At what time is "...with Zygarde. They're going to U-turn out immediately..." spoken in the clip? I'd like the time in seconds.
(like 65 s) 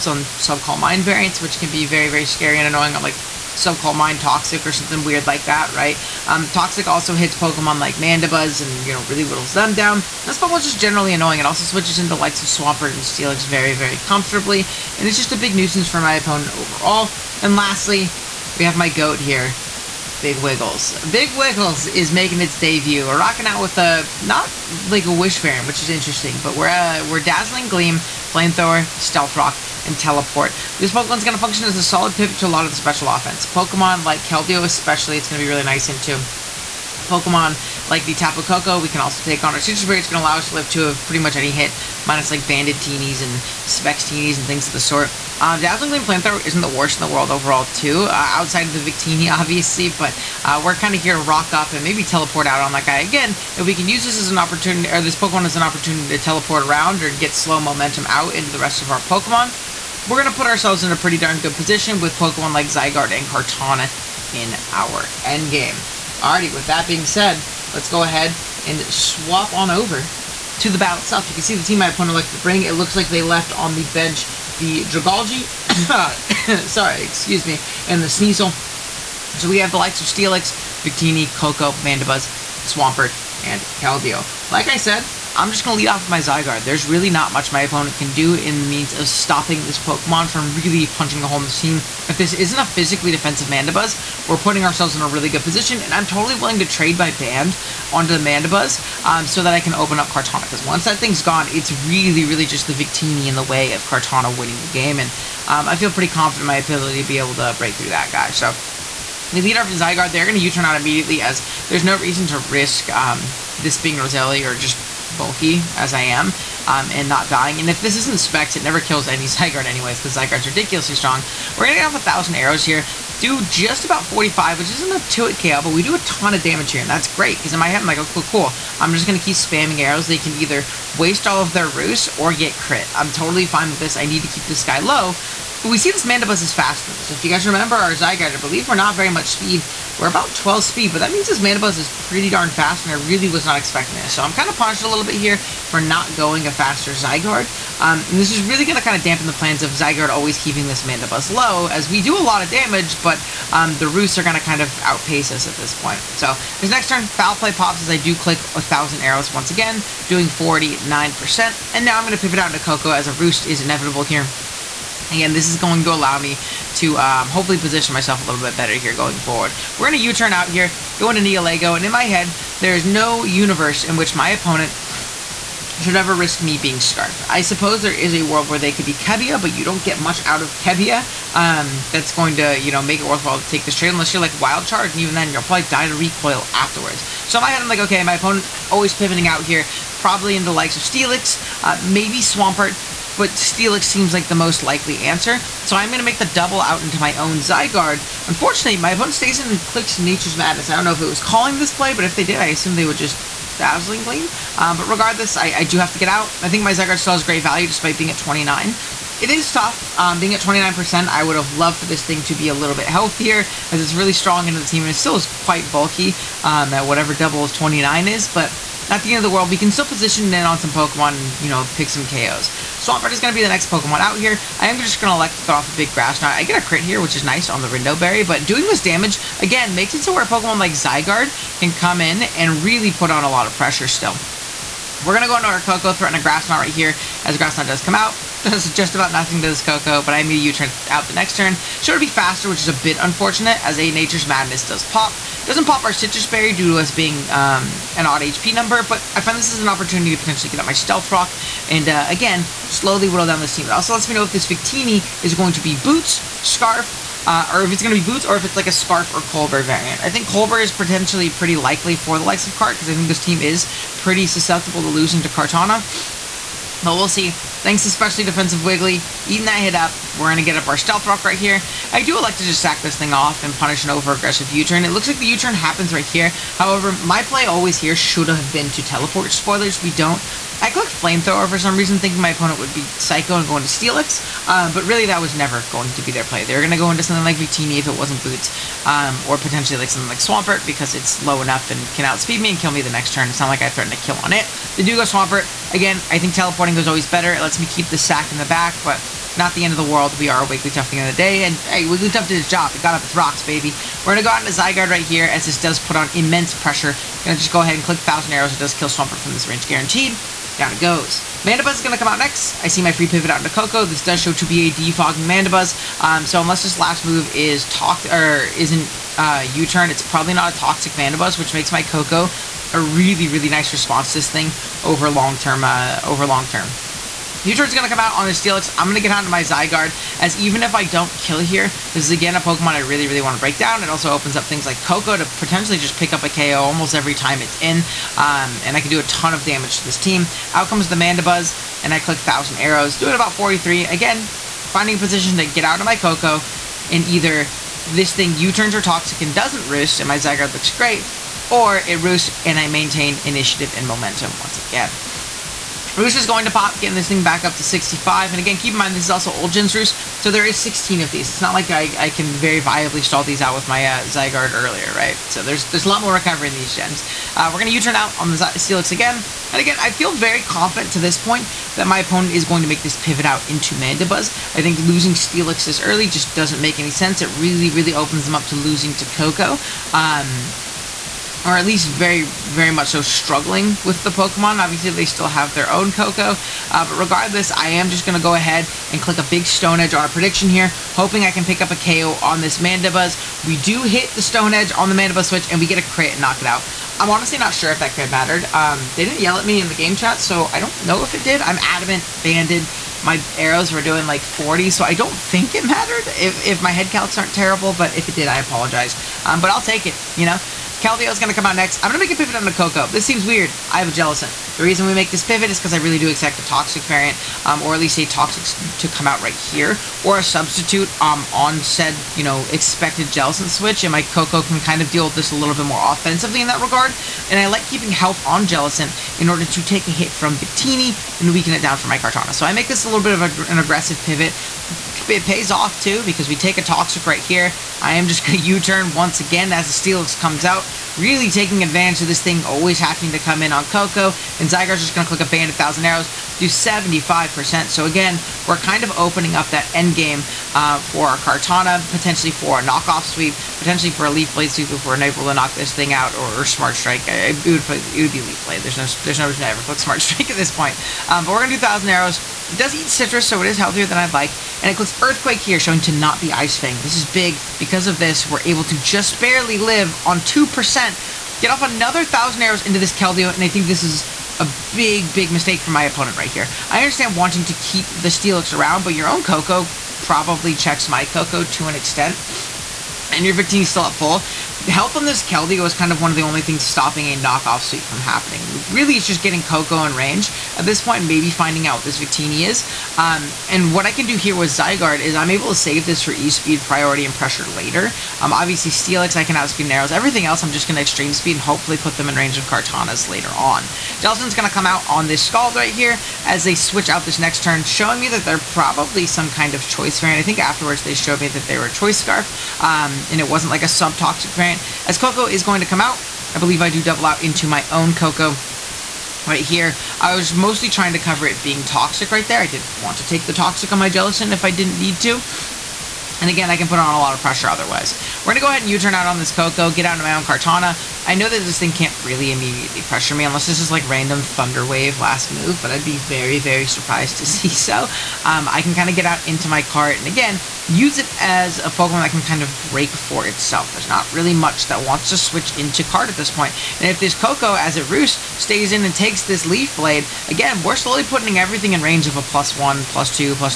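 109 s.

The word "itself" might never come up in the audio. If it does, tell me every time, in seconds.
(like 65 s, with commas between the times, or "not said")
70 s, 543 s.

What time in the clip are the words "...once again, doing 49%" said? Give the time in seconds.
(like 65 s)
159 s.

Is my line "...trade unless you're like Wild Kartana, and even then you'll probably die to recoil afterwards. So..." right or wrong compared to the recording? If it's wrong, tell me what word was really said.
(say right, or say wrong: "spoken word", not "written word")
wrong: "Charge", not "Kartana".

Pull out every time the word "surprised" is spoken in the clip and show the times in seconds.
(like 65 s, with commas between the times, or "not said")
536 s.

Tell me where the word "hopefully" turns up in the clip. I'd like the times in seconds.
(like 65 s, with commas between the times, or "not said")
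167 s, 501 s.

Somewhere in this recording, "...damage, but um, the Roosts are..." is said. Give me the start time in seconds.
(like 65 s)
152 s.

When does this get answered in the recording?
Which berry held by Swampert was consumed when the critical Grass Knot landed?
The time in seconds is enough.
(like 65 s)
227 s.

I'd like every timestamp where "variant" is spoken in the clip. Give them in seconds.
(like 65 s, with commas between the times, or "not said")
1 s, 25 s, 259 s, 416 s, 510 s, 514 s.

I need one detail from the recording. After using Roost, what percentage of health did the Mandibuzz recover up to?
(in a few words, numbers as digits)
65.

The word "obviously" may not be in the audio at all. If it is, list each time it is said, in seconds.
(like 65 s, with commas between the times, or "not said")
49 s, 384 s, 498 s.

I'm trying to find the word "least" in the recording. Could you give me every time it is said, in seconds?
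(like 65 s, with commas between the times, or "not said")
381 s, 417 s.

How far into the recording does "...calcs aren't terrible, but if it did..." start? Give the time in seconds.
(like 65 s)
406 s.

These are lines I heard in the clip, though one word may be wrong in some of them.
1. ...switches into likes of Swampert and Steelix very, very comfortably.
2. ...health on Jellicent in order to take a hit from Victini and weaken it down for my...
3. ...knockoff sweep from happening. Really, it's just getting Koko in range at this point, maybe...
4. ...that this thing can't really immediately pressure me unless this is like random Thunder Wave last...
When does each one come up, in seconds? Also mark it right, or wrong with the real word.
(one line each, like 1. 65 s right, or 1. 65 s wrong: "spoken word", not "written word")
1. 11 s right
2. 427 s right
3. 487 s right
4. 531 s right.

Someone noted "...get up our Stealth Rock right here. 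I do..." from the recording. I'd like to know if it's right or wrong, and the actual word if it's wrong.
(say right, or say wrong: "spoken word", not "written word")
right.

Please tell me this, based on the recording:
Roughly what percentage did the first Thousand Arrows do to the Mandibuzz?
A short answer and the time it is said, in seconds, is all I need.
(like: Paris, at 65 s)
45, at 124 s.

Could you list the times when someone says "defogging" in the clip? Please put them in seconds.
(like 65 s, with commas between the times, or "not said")
314 s.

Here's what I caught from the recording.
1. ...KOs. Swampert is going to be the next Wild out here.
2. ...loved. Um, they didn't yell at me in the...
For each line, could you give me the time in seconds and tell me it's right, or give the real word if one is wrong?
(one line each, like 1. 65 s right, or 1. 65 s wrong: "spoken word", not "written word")
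1. 222 s wrong: "Pokemon", not "Wild"
2. 398 s wrong: "mattered", not "loved".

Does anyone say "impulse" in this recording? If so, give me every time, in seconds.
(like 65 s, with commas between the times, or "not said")
not said.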